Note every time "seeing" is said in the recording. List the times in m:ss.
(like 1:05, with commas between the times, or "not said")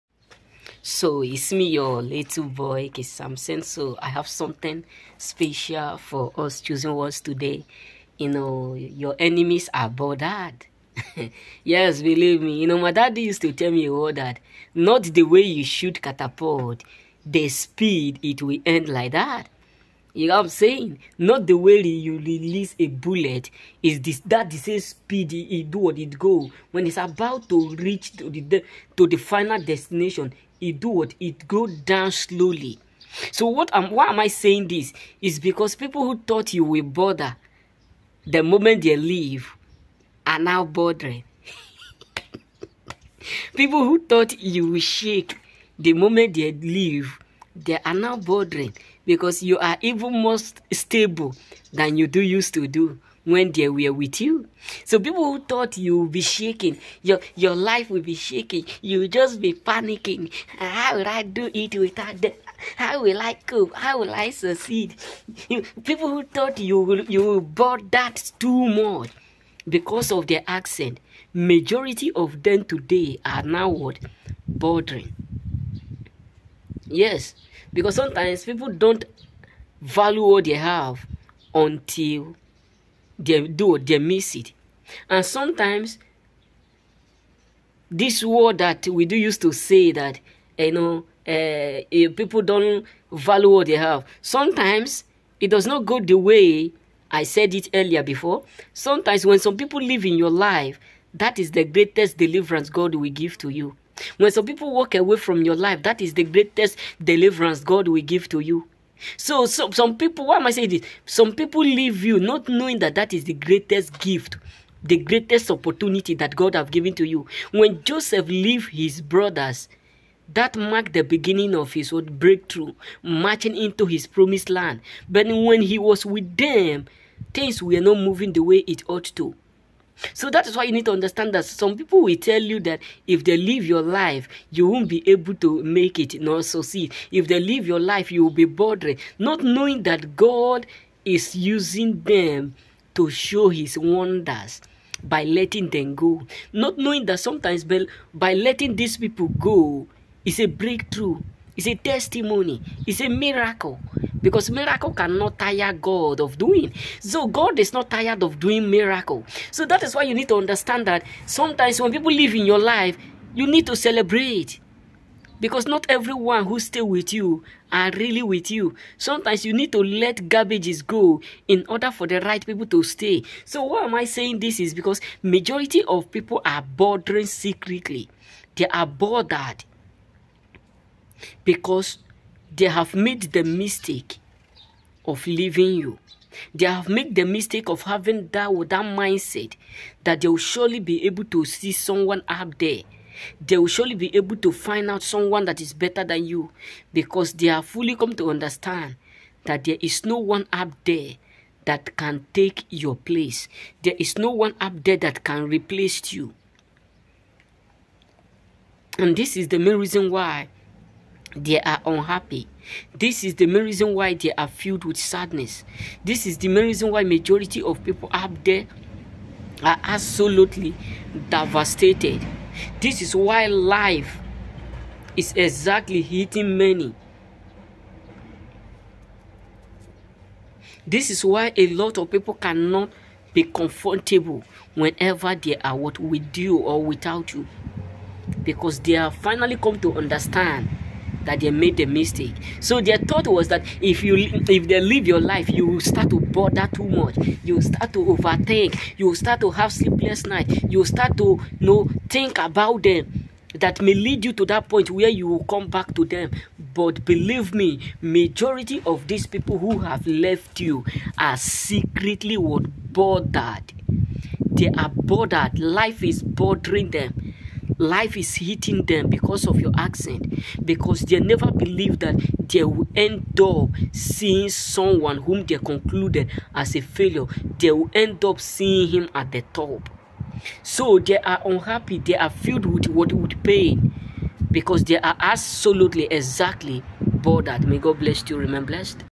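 4:33, 4:38.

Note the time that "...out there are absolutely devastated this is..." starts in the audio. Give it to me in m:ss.
3:38.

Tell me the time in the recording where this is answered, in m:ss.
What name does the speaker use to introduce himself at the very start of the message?
0:02.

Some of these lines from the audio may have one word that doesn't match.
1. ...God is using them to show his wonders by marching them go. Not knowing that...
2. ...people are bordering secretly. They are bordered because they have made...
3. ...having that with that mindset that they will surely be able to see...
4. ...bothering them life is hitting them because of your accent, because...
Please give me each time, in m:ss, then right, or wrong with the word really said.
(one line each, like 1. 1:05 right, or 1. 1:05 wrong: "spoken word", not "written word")
1. 2:20 wrong: "letting", not "marching"
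2. 2:56 right
3. 3:07 right
4. 4:26 right.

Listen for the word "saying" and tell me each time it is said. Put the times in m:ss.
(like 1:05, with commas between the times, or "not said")
0:20, 0:34, 1:50, 2:54.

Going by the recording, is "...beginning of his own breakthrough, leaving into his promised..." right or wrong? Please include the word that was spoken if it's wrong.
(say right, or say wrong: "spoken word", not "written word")
wrong: "marching", not "leaving".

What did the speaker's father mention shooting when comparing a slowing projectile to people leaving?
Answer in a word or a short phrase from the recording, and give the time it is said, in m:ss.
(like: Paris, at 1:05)
Catapult, at 0:16.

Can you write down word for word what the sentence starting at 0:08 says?
You know, your enemies are bothered.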